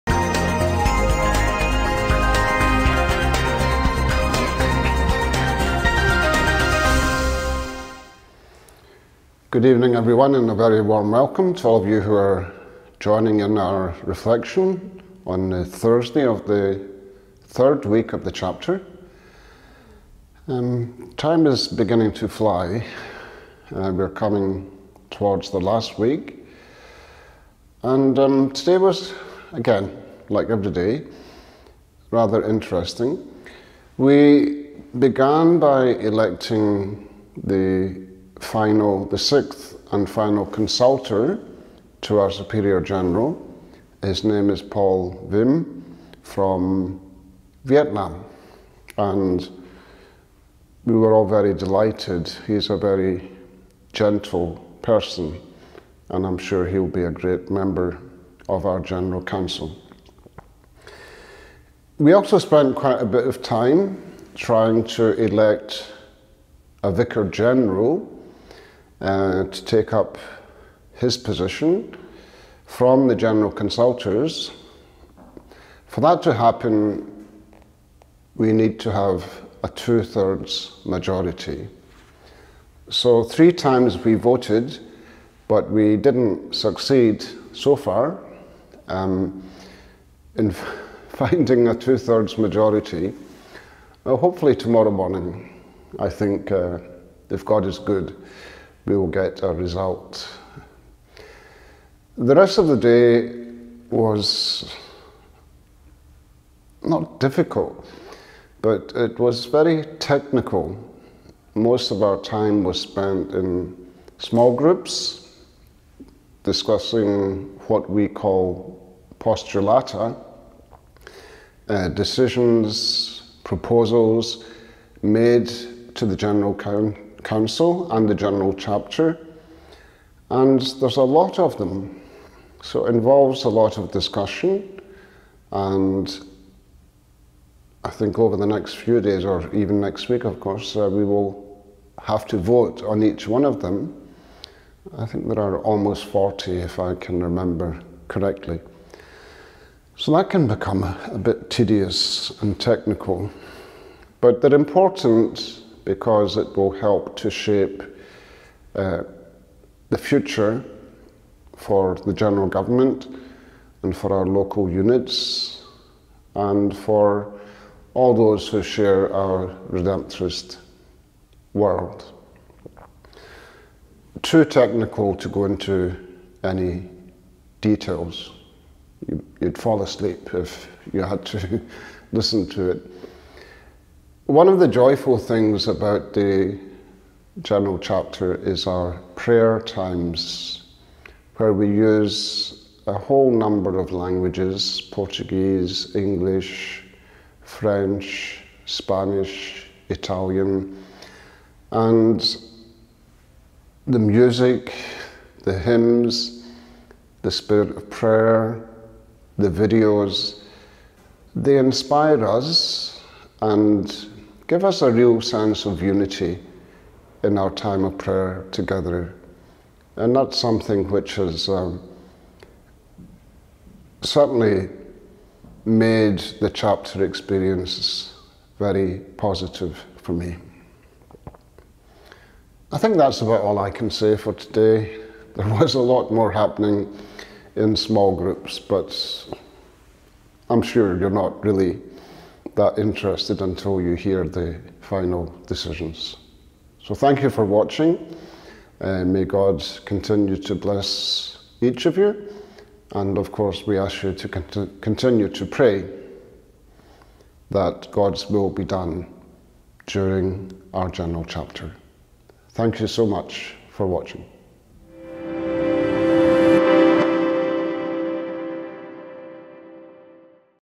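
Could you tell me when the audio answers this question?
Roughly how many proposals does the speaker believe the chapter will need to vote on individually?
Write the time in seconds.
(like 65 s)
145 s.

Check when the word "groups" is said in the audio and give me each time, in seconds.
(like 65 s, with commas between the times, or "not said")
114 s, 238 s.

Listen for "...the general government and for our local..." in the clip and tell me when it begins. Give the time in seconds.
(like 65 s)
162 s.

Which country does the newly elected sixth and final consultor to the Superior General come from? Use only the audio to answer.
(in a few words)
Vietnam.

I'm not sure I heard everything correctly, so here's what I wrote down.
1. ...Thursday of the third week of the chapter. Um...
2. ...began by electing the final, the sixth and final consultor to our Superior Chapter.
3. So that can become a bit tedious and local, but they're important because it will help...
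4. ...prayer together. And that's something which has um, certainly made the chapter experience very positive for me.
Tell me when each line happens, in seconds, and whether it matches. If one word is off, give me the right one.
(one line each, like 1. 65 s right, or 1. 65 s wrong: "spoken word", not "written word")
1. 15 s right
2. 34 s wrong: "General", not "Chapter"
3. 149 s wrong: "technical", not "local"
4. 217 s right.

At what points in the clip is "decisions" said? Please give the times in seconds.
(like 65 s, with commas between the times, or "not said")
121 s, 245 s.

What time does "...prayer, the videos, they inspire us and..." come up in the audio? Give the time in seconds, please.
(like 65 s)
207 s.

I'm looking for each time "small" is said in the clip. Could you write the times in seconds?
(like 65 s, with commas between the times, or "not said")
114 s, 237 s.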